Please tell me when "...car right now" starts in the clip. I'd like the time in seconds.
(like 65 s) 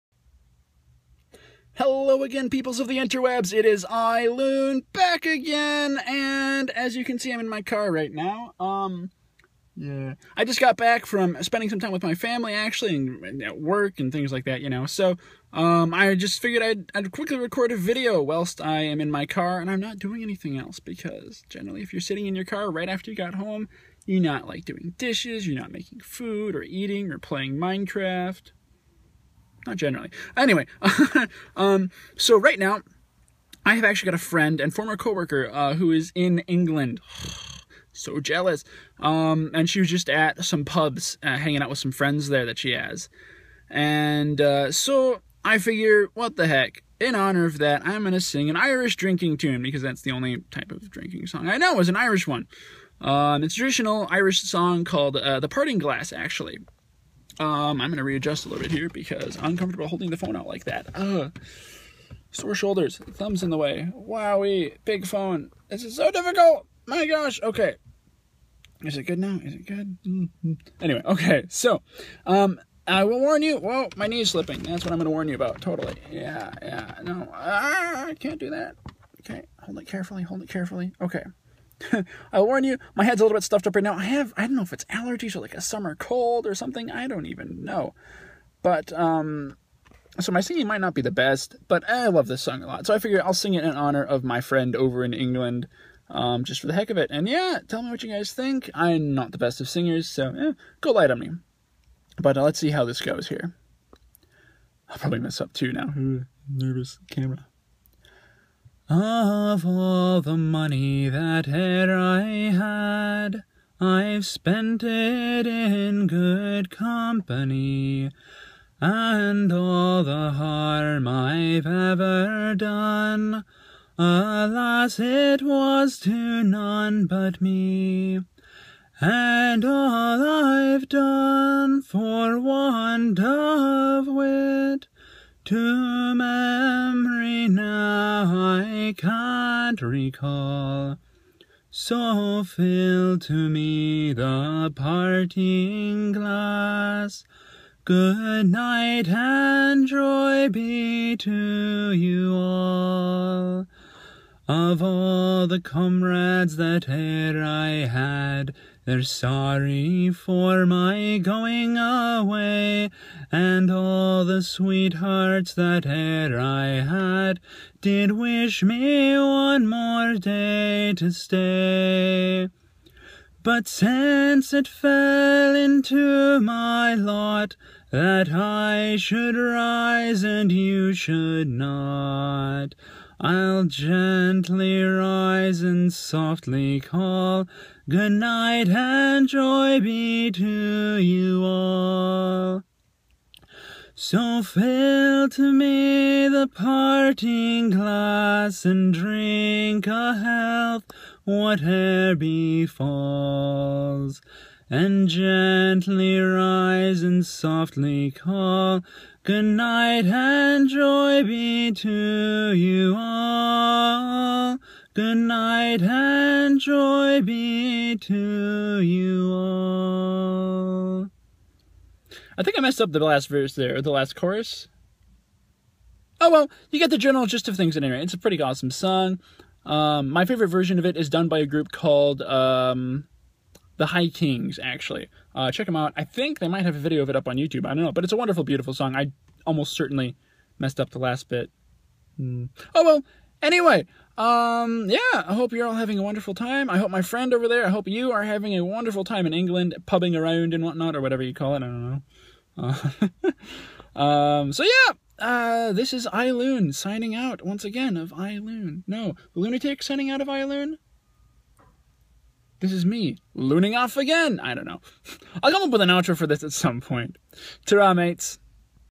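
7 s.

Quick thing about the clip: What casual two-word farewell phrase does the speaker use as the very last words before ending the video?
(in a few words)
Ta-ra, mates.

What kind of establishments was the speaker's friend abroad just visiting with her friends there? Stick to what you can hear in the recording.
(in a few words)
pubs.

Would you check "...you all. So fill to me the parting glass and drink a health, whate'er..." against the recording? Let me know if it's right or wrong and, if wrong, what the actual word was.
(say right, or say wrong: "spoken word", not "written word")
right.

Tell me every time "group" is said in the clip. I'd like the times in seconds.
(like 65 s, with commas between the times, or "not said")
231 s.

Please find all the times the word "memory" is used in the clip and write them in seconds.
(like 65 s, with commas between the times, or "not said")
136 s.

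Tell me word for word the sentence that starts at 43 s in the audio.
And uh, so I figure, what the heck?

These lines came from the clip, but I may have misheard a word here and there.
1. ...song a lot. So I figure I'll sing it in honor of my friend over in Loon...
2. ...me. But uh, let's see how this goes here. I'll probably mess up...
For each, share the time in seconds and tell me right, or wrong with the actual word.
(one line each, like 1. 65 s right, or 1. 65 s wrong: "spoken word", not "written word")
1. 92 s wrong: "England", not "Loon"
2. 101 s right.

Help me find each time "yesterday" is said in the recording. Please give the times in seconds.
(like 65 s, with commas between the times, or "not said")
not said.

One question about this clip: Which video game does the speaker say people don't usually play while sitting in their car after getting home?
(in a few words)
Minecraft.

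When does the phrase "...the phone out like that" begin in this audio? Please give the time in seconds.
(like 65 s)
60 s.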